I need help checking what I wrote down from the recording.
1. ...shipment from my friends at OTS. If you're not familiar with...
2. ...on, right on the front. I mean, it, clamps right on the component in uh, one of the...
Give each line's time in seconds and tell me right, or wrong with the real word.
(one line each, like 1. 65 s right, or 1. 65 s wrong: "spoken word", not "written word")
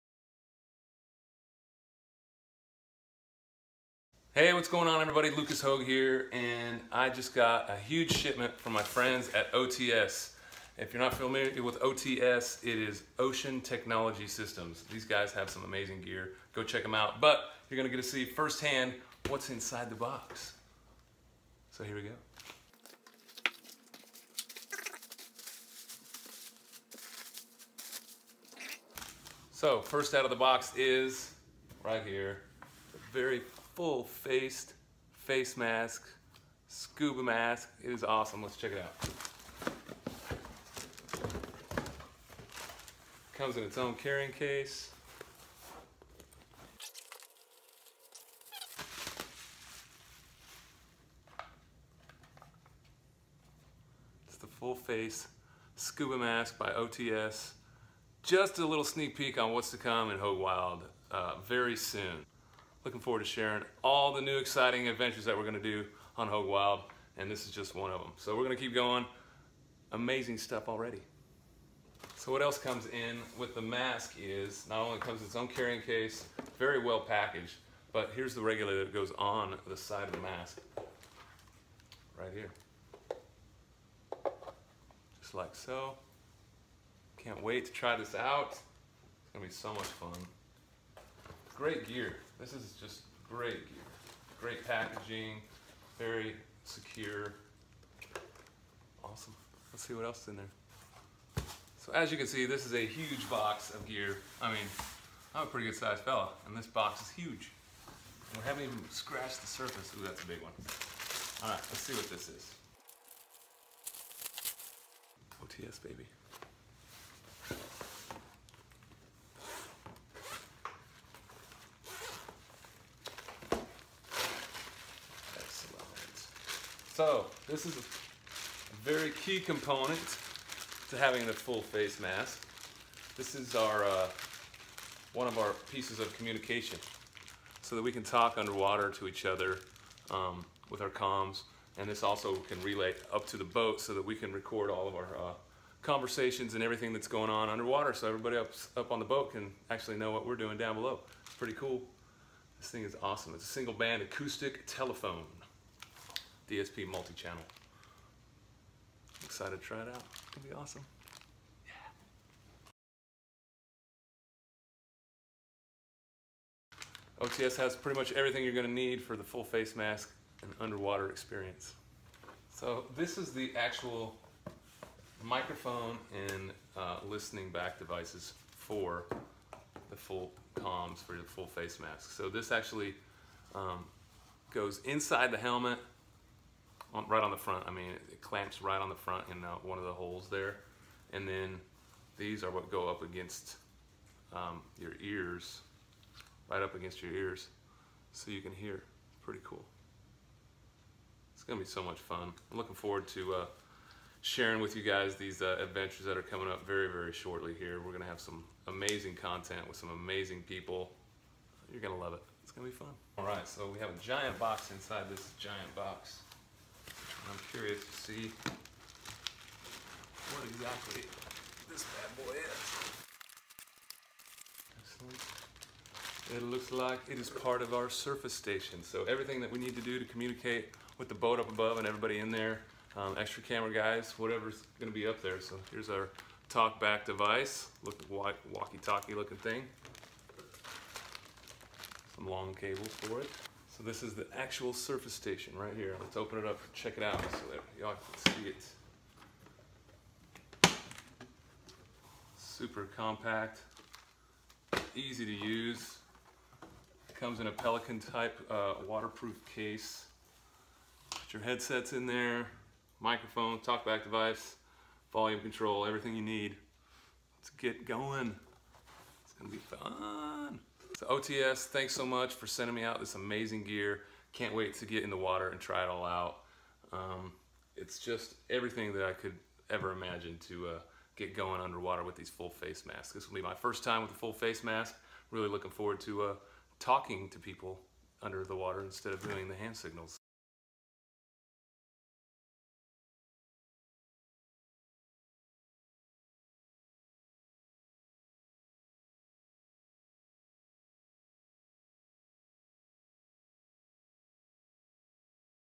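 1. 8 s right
2. 186 s wrong: "front", not "component".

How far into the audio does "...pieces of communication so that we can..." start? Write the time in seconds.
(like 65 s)
135 s.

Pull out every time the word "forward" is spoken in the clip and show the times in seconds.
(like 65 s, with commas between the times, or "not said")
62 s, 202 s, 285 s.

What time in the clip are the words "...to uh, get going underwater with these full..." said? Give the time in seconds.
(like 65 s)
280 s.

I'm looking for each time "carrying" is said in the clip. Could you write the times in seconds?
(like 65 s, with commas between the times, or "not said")
43 s, 75 s.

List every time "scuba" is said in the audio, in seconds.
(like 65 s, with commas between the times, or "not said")
36 s, 55 s.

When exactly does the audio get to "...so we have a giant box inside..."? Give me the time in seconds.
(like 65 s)
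213 s.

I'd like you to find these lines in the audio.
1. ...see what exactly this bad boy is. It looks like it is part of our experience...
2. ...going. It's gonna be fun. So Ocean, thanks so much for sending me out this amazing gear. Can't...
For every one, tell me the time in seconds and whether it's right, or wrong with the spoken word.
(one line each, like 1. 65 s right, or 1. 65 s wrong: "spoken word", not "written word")
1. 217 s wrong: "surface", not "experience"
2. 267 s wrong: "OTS", not "Ocean".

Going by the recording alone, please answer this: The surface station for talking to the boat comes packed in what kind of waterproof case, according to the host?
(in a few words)
Pelican type.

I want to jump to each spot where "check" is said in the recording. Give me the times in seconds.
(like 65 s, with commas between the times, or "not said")
16 s, 38 s, 246 s.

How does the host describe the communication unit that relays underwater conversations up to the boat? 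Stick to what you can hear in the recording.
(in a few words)
single band acoustic telephone.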